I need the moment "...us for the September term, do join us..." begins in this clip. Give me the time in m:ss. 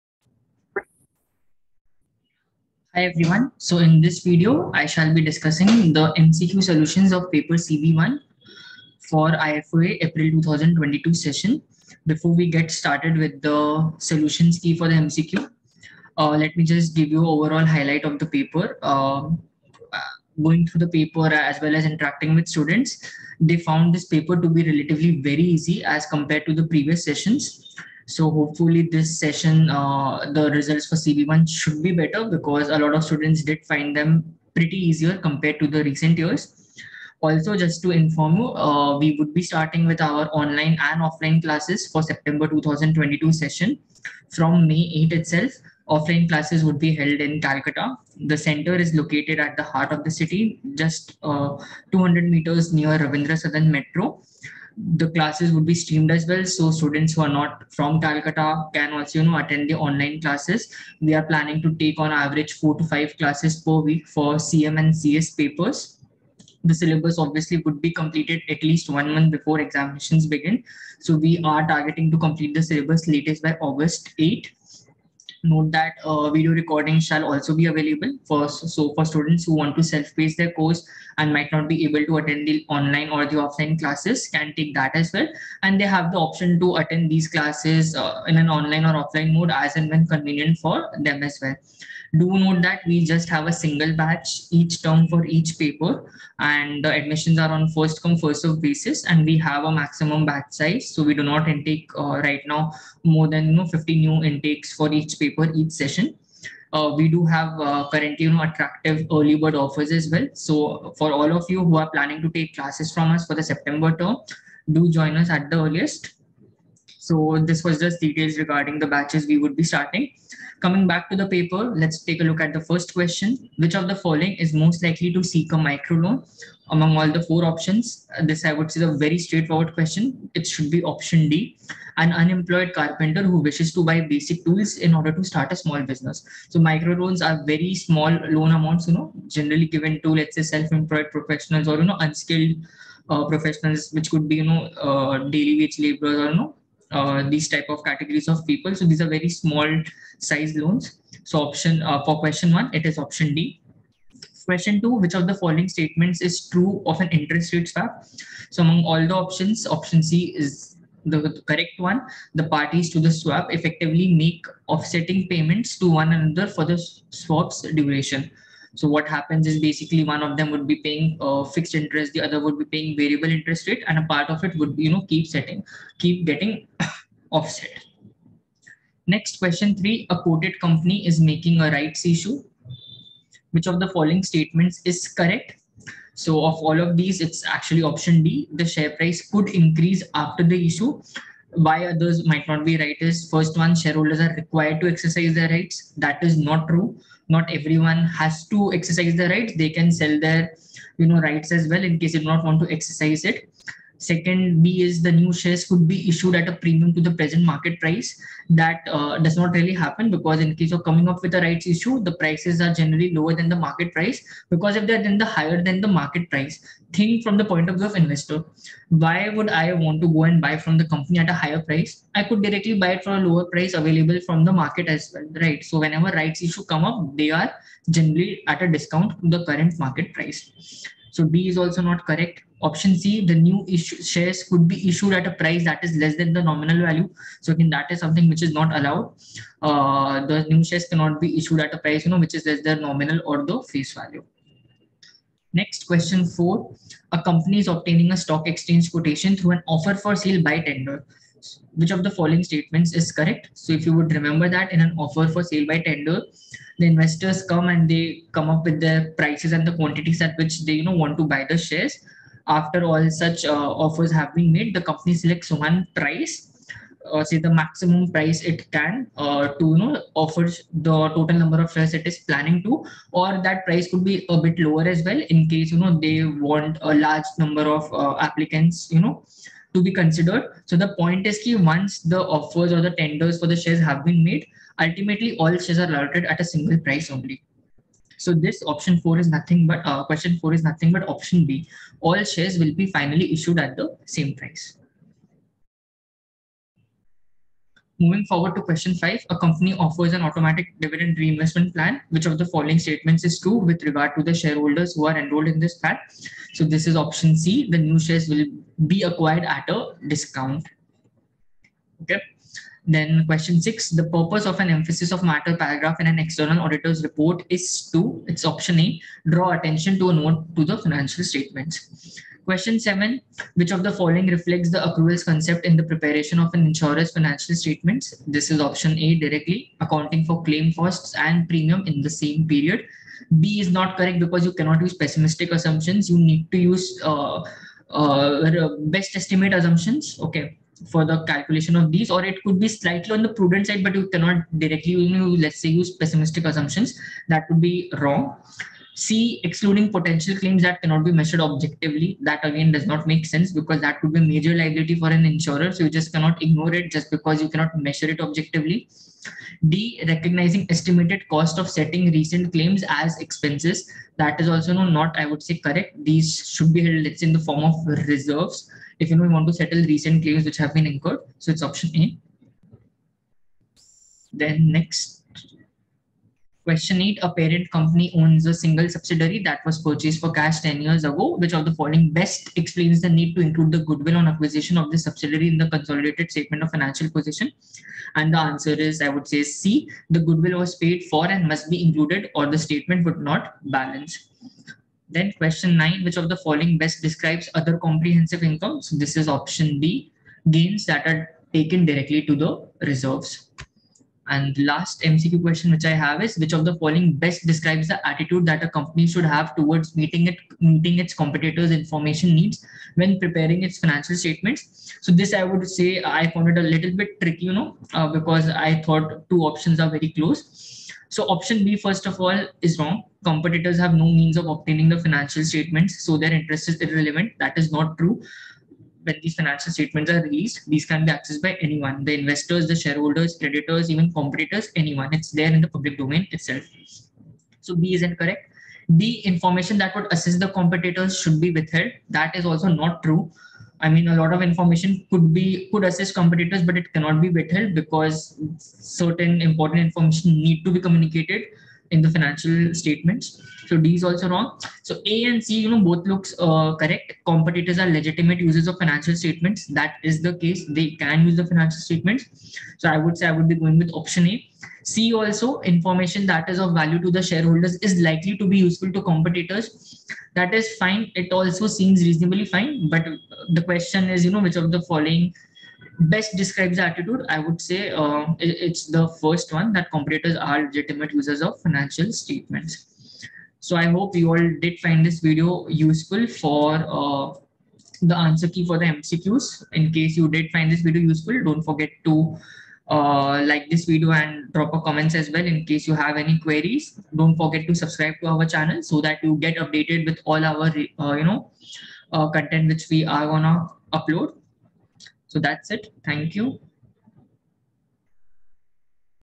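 1:53.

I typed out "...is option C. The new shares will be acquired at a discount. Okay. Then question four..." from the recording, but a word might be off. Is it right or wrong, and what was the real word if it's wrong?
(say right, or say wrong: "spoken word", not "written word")
wrong: "six", not "four".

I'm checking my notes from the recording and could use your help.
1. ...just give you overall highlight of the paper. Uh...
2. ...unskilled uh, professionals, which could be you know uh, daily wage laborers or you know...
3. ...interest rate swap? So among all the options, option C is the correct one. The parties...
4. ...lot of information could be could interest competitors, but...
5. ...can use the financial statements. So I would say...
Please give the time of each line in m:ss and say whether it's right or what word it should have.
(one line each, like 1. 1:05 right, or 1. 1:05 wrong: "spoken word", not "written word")
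1. 0:16 right
2. 2:21 right
3. 2:37 right
4. 7:24 wrong: "assist", not "interest"
5. 7:40 right.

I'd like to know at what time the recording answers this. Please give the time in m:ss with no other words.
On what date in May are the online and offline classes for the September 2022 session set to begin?
0:44.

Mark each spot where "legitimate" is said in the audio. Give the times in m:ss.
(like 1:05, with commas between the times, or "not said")
7:37, 8:00.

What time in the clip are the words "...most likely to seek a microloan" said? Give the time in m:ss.
2:04.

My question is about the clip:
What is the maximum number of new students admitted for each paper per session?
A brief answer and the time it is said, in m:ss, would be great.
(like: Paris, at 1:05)
50, at 1:43.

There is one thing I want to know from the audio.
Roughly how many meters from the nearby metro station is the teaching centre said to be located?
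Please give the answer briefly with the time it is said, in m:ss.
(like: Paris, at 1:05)
200, at 0:51.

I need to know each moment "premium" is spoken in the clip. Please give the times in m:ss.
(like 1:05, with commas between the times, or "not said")
3:26, 5:31.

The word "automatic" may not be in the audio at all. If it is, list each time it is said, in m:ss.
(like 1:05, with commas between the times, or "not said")
5:00.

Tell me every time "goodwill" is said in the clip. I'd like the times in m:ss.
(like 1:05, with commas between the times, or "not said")
6:23, 6:30.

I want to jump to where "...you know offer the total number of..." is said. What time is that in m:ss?
4:29.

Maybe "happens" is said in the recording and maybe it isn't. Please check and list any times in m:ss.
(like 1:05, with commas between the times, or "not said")
2:49, 3:29.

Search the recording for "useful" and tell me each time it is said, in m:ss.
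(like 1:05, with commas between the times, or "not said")
7:48, 8:05, 8:11.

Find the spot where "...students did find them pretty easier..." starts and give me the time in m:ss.
0:33.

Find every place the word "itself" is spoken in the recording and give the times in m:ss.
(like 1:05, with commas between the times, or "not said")
0:45, 7:16.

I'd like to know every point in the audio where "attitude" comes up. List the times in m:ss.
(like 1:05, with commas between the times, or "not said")
6:48, 7:56.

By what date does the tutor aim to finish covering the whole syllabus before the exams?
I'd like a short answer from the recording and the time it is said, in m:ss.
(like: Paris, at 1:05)
August 8, at 1:13.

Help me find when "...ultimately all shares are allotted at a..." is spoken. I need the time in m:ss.
4:44.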